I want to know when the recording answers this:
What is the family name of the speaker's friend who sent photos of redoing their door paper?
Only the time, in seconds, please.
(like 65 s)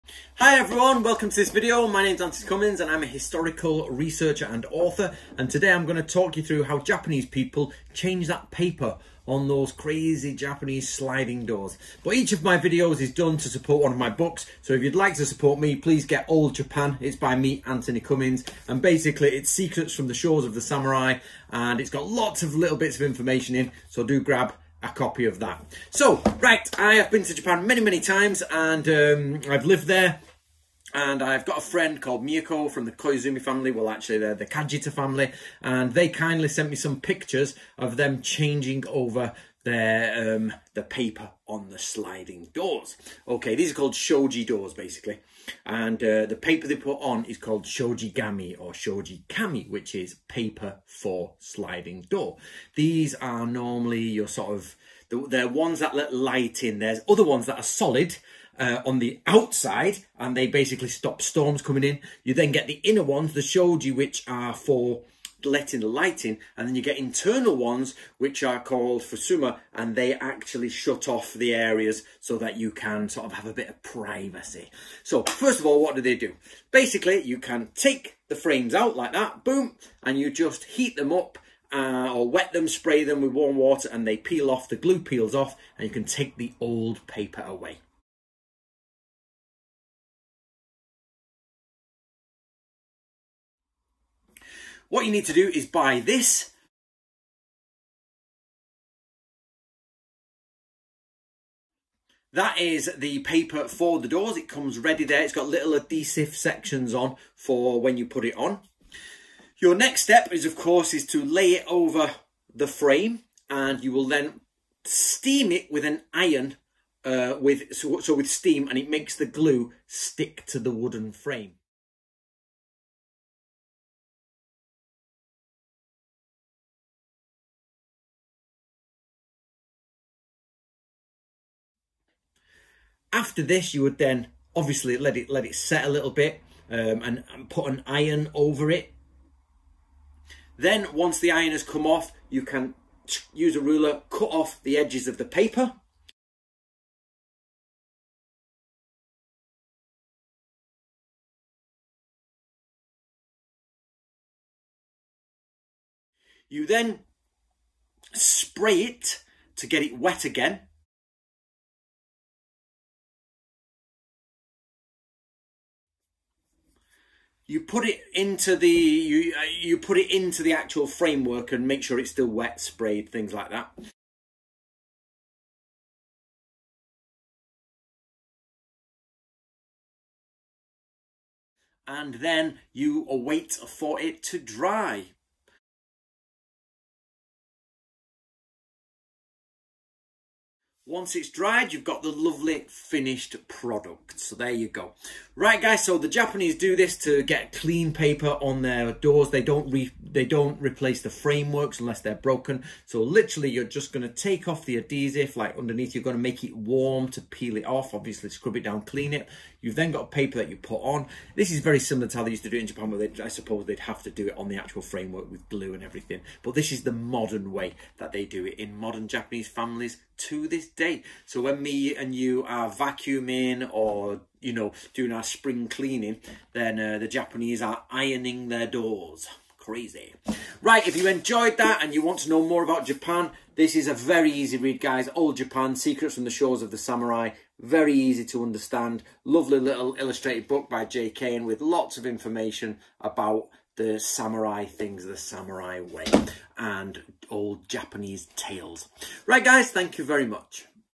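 34 s.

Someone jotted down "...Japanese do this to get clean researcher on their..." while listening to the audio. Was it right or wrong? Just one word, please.
wrong.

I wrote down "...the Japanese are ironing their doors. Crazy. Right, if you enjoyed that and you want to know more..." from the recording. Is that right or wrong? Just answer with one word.
right.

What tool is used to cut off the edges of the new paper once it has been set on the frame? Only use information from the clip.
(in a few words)
a ruler.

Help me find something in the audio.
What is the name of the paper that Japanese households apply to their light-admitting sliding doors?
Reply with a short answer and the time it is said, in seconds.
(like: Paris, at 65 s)
shoji gami, at 47 s.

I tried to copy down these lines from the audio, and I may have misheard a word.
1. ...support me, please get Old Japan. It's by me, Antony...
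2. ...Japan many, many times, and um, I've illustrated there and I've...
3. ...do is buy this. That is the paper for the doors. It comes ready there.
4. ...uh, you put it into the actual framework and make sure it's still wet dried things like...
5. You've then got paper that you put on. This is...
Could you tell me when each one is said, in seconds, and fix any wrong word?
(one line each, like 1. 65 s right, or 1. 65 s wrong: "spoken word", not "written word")
1. 15 s right
2. 27 s wrong: "lived", not "illustrated"
3. 95 s right
4. 169 s wrong: "sprayed", not "dried"
5. 209 s right.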